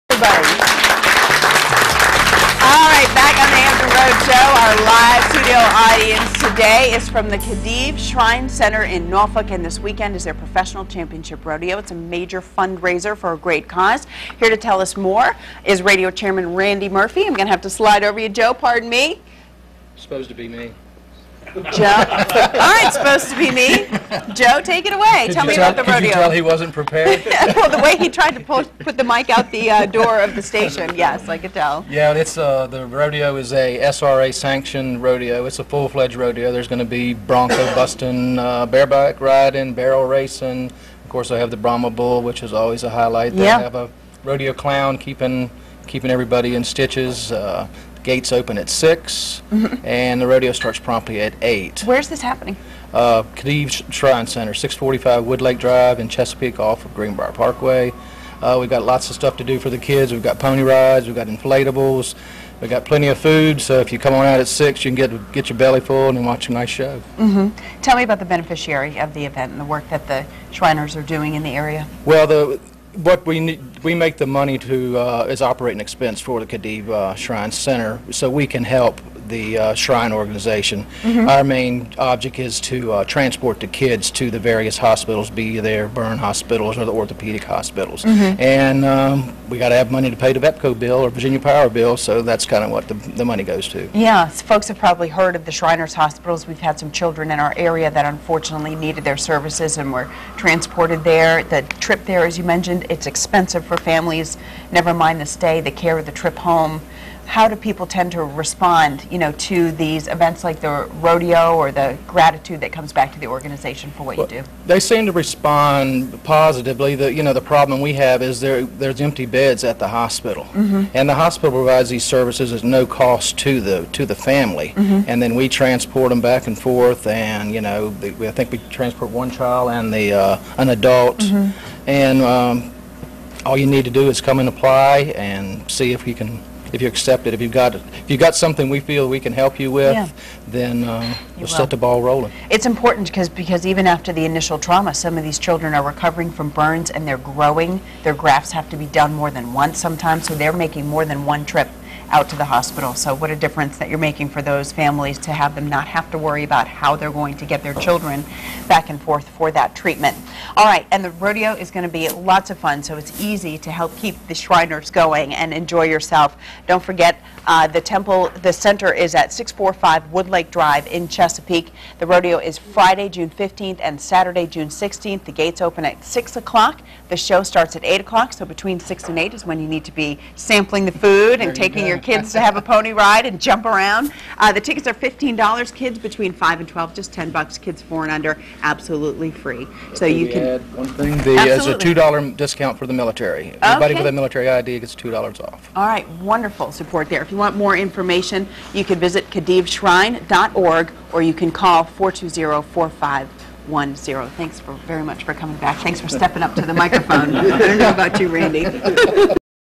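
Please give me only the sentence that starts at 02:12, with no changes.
and um, all you need to do is come and apply and see if you can if you accept it.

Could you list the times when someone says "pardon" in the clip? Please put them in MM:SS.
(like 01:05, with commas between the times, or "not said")
00:18.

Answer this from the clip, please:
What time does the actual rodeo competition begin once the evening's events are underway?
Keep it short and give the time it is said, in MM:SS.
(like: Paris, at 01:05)
8, at 00:50.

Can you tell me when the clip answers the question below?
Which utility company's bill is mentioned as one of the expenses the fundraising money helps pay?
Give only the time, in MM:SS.
01:30.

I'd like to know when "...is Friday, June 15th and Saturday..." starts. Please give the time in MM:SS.
02:52.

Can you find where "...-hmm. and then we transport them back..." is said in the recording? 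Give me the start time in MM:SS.
02:04.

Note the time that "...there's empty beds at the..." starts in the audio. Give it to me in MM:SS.
01:58.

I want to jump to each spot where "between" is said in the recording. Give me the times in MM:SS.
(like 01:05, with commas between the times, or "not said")
02:58, 03:05.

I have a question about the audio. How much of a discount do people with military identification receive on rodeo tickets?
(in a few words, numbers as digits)
$2.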